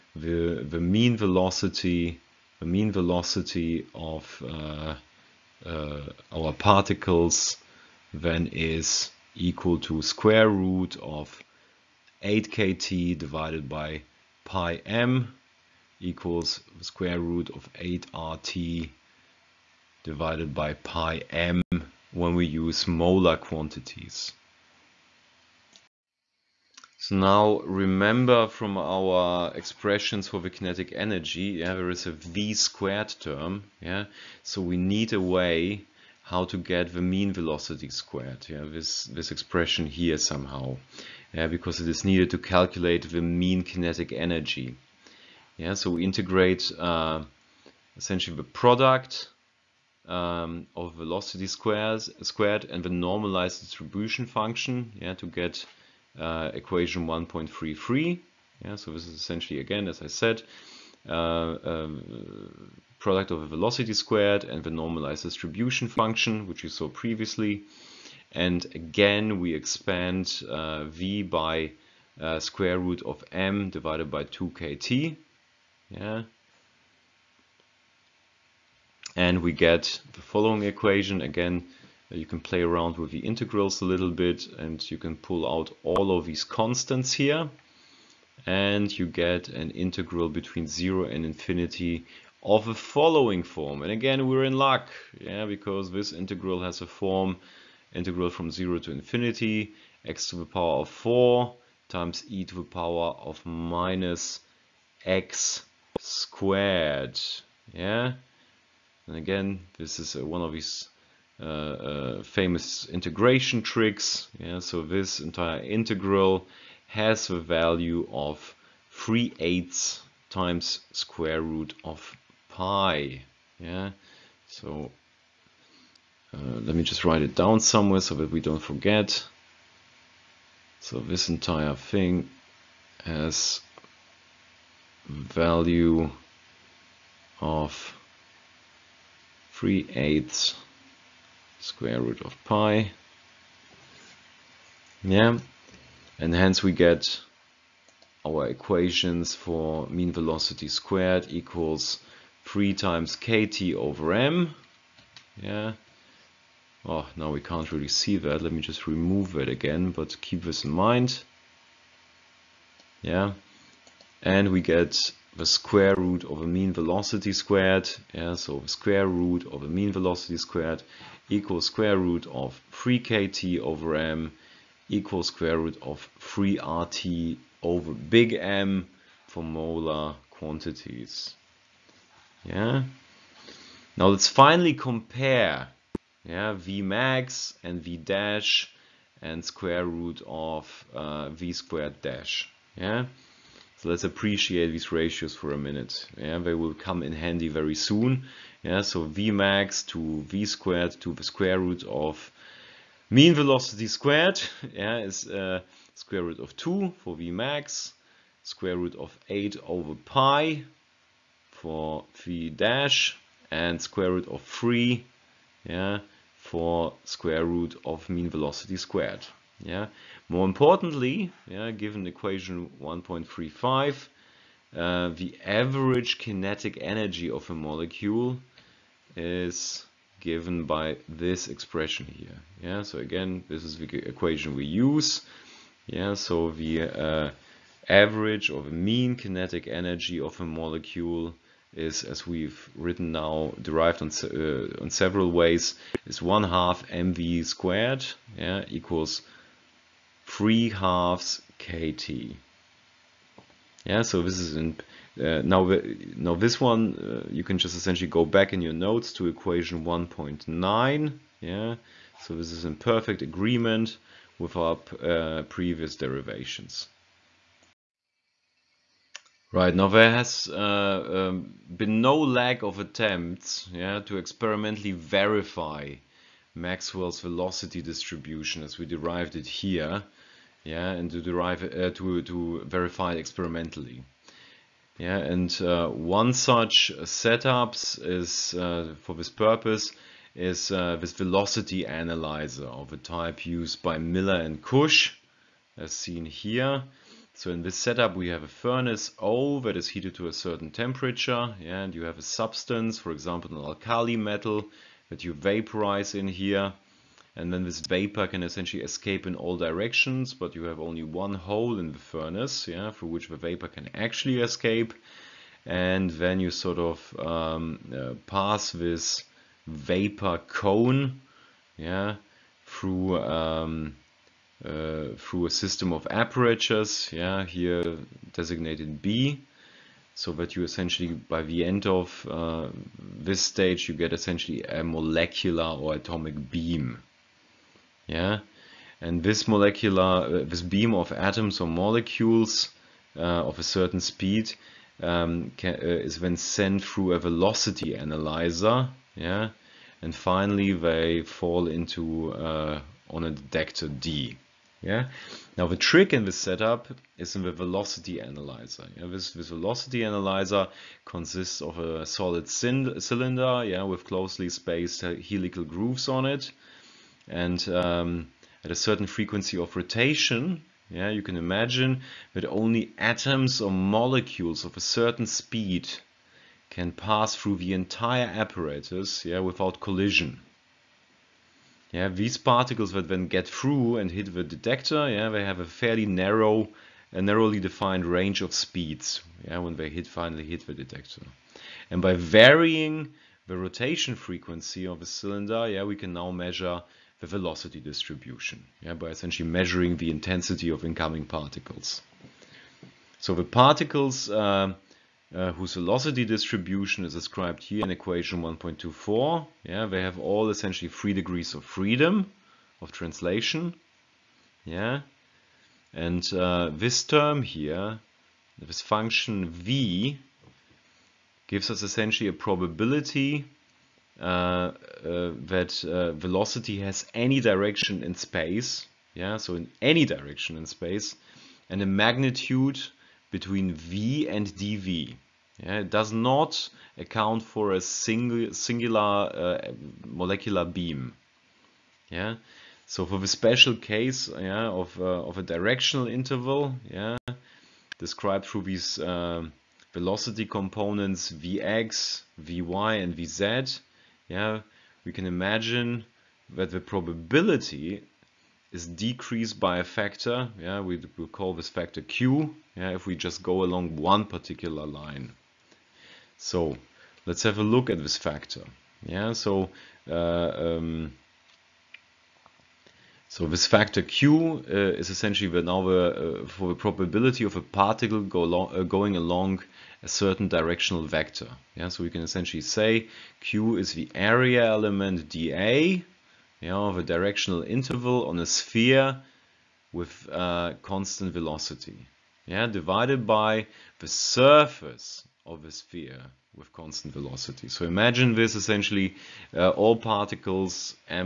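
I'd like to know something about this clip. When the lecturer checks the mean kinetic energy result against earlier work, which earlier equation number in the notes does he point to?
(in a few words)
1.9.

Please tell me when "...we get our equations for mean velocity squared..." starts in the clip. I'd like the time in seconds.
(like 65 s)
146 s.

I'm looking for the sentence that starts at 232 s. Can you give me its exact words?
Yeah, so again, this is the equation we use.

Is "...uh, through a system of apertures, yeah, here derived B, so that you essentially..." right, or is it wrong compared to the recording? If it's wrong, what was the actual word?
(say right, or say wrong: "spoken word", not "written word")
wrong: "designated", not "derived".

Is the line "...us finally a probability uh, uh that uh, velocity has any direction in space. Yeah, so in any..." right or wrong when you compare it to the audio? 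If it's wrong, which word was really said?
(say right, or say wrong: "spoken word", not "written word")
wrong: "essentially", not "finally".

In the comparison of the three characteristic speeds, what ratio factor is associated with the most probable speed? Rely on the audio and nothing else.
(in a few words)
square root of 2.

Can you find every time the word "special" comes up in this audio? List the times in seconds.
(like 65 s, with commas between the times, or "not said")
443 s.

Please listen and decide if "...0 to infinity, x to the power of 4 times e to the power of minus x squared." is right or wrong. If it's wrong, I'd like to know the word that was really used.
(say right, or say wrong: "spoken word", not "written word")
right.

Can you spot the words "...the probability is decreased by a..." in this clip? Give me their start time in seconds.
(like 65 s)
456 s.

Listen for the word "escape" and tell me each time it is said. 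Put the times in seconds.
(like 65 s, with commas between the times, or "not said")
308 s, 314 s.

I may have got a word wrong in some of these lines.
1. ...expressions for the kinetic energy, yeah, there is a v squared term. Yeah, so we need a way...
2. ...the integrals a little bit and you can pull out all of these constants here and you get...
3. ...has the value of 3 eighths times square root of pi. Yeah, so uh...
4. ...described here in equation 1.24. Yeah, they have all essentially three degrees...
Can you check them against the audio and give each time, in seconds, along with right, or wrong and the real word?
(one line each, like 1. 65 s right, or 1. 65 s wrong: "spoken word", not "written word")
1. 29 s right
2. 83 s right
3. 116 s right
4. 407 s right.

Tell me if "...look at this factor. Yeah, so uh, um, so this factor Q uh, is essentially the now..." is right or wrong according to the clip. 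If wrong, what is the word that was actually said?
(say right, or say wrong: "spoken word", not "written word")
right.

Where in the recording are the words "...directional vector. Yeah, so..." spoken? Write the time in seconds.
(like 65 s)
480 s.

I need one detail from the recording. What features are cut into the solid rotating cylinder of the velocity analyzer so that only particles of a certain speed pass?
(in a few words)
helical grooves.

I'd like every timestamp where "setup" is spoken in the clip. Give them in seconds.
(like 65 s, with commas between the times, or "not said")
287 s, 297 s, 356 s.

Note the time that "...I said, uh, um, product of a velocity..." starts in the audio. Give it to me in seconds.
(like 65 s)
60 s.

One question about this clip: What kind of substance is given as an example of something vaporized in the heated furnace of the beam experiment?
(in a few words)
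an alkali metal.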